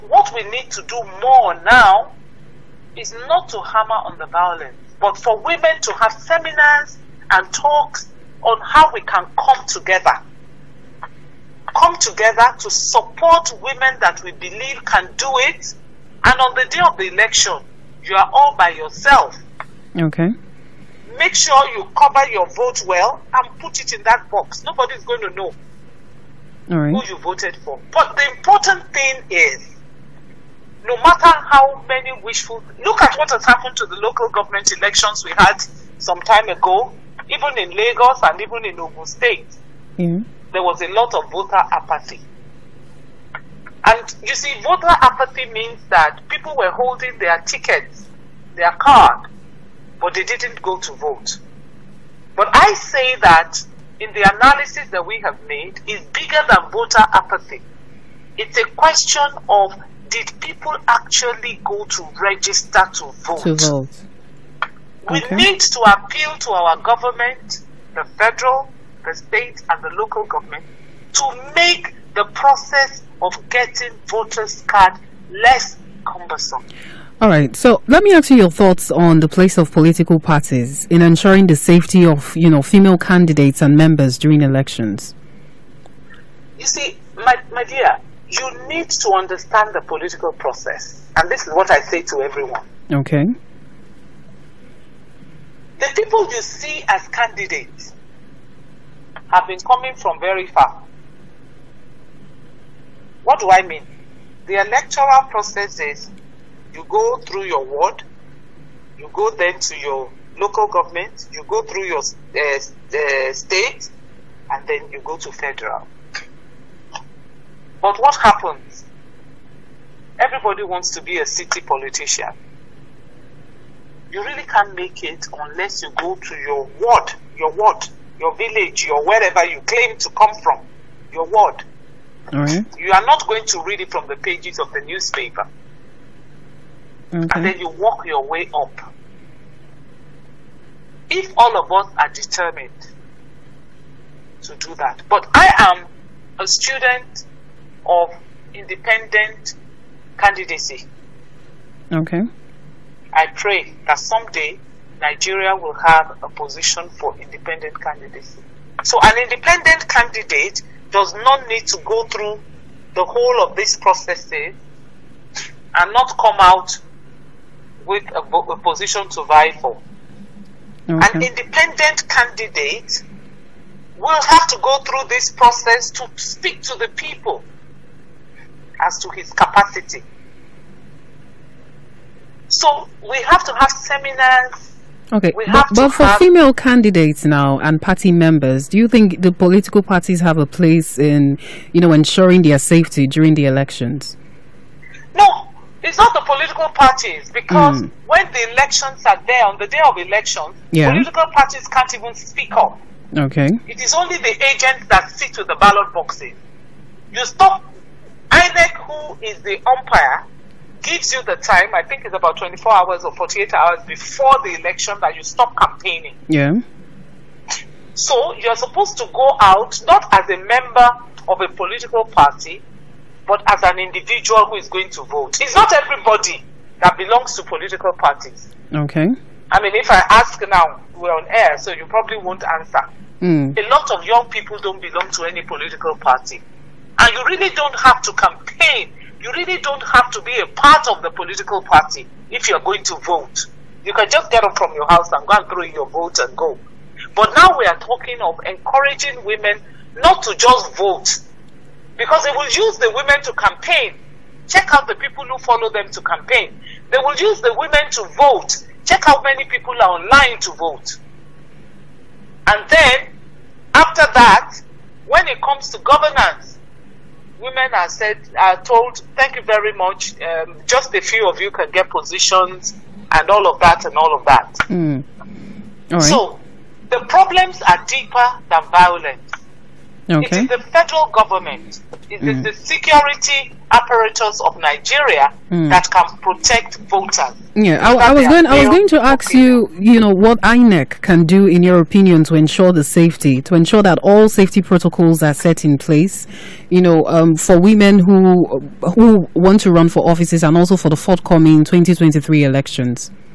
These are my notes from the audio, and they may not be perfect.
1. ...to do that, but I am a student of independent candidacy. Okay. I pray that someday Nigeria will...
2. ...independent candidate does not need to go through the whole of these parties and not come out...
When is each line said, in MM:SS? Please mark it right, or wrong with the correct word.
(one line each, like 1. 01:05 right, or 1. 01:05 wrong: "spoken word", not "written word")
1. 02:24 right
2. 02:39 wrong: "processes", not "parties".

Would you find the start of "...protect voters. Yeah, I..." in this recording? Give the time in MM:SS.
04:46.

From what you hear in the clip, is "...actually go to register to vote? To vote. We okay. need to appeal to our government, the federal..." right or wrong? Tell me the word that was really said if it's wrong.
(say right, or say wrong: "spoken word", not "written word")
right.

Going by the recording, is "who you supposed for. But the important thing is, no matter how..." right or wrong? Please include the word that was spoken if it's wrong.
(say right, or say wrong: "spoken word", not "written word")
wrong: "voted", not "supposed".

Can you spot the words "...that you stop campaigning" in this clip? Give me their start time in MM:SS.
03:35.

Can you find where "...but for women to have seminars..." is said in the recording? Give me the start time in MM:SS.
00:04.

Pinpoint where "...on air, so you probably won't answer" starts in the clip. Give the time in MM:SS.
03:51.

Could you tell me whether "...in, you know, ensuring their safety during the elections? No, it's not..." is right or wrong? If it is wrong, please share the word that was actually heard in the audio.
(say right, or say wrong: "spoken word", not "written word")
right.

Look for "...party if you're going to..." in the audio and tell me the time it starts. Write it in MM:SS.
04:01.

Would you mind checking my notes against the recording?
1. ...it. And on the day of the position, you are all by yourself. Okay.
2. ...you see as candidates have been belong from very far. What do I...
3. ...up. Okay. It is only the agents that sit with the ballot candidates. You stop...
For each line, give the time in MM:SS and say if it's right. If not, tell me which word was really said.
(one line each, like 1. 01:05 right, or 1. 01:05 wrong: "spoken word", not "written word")
1. 00:15 wrong: "election", not "position"
2. 01:36 wrong: "coming", not "belong"
3. 03:22 wrong: "boxes", not "candidates".